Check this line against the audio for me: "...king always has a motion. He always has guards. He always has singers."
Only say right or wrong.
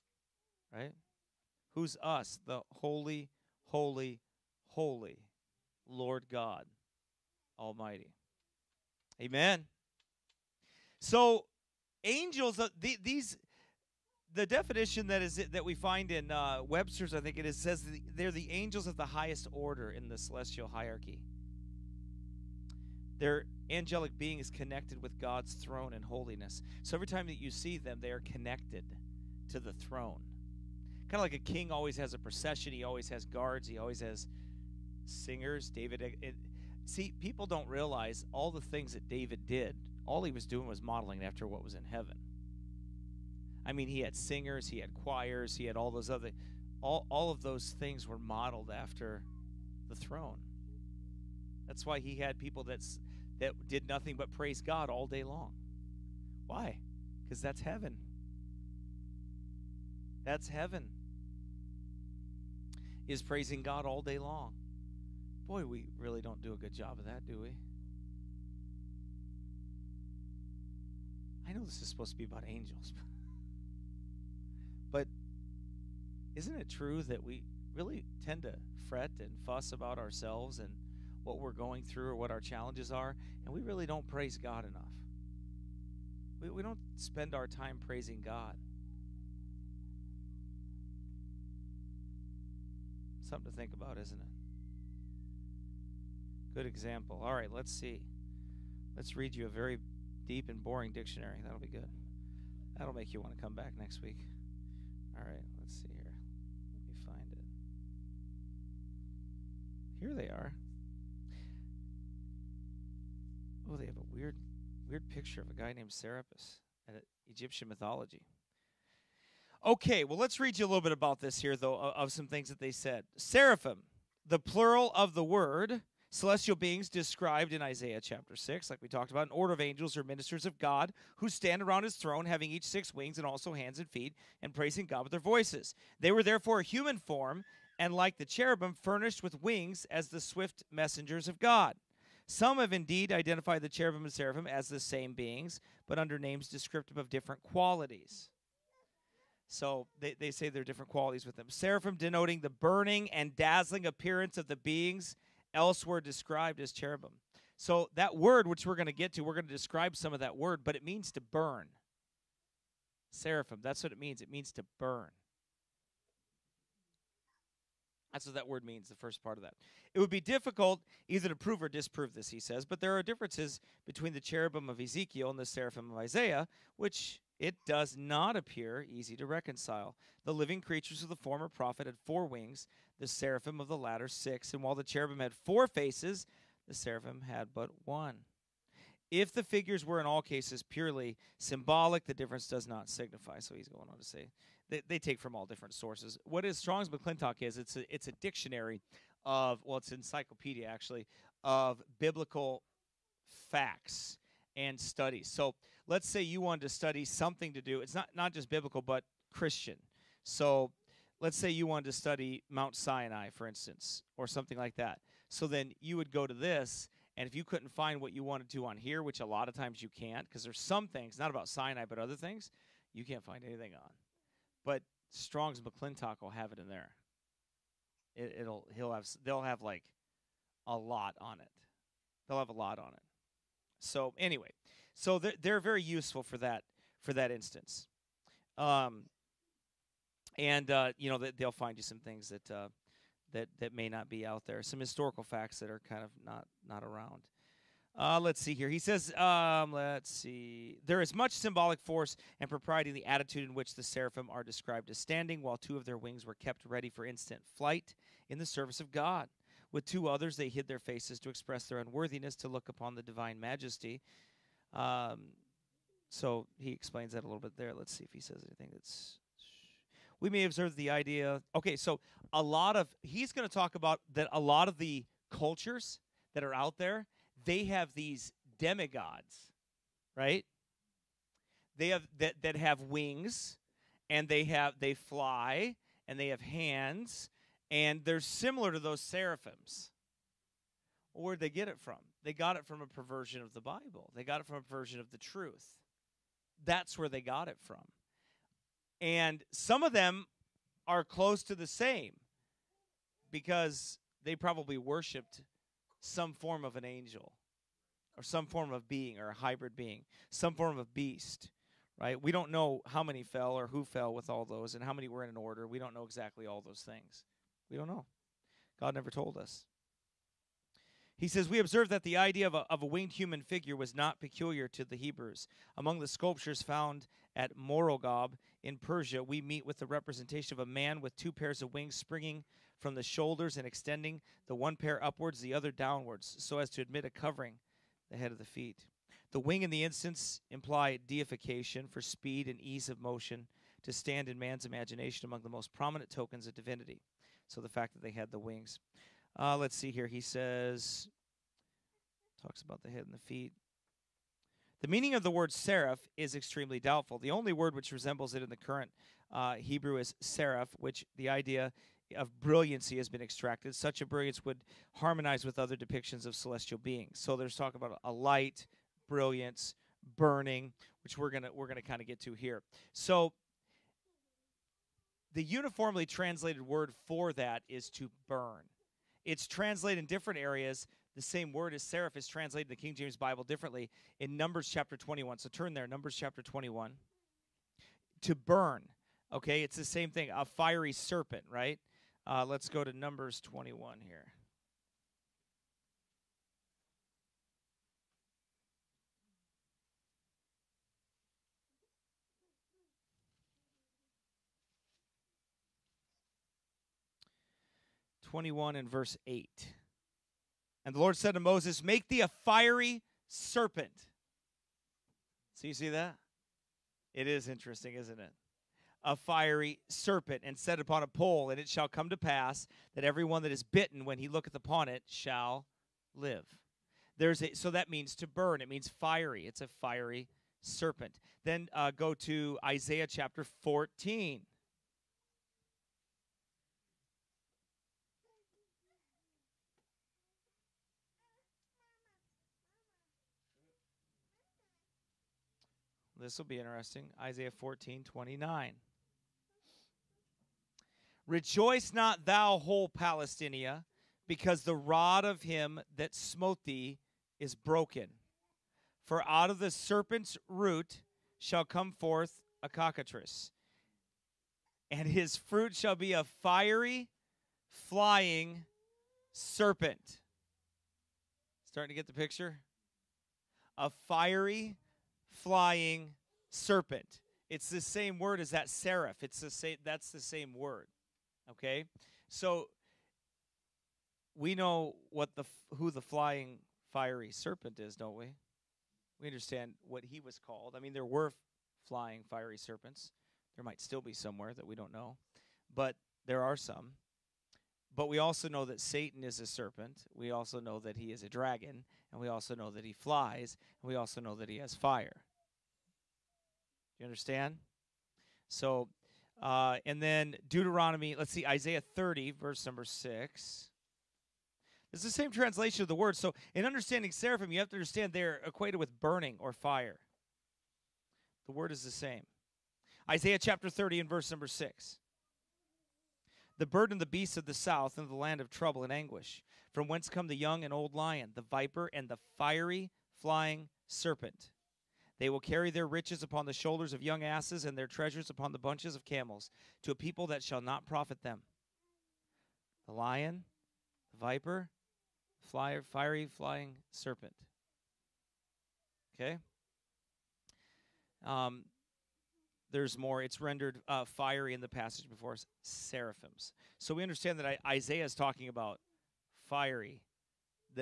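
wrong.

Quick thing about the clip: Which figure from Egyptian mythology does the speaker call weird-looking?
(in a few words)
Serapis.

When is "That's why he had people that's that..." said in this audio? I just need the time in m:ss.
0:51.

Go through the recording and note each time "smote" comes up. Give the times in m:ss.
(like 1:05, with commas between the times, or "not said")
7:36.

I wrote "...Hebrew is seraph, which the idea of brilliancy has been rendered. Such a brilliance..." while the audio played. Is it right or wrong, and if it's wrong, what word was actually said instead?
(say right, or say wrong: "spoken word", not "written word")
wrong: "extracted", not "rendered".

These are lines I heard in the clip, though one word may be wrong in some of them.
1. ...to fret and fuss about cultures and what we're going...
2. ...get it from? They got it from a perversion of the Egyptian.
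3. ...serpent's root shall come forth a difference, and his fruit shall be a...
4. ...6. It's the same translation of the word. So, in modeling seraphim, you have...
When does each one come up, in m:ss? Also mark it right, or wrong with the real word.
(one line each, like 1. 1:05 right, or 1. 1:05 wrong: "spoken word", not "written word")
1. 1:18 wrong: "ourselves", not "cultures"
2. 4:51 wrong: "Bible", not "Egyptian"
3. 7:39 wrong: "cockatrice", not "difference"
4. 8:32 wrong: "understanding", not "modeling".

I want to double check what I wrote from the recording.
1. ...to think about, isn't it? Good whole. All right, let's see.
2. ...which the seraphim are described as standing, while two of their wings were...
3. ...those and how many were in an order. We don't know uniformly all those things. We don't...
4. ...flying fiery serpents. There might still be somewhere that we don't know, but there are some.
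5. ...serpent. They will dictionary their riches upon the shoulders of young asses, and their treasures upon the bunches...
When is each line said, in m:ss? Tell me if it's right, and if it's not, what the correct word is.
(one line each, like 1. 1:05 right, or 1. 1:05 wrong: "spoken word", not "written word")
1. 1:33 wrong: "example", not "whole"
2. 4:13 right
3. 5:14 wrong: "exactly", not "uniformly"
4. 8:11 right
5. 8:53 wrong: "carry", not "dictionary".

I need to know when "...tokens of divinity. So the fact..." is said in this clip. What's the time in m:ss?
5:46.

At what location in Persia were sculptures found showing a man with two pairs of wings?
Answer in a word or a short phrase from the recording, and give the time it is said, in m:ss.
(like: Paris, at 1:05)
Murghab, at 5:27.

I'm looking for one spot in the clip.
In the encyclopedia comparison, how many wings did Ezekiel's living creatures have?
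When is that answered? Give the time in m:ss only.
3:02.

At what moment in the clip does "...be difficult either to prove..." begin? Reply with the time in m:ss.
2:50.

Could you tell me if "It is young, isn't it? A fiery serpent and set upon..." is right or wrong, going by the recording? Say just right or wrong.
wrong.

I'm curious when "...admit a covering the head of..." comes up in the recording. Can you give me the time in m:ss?
5:36.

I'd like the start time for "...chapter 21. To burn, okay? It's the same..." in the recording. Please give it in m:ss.
6:26.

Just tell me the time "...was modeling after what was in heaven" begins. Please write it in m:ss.
0:40.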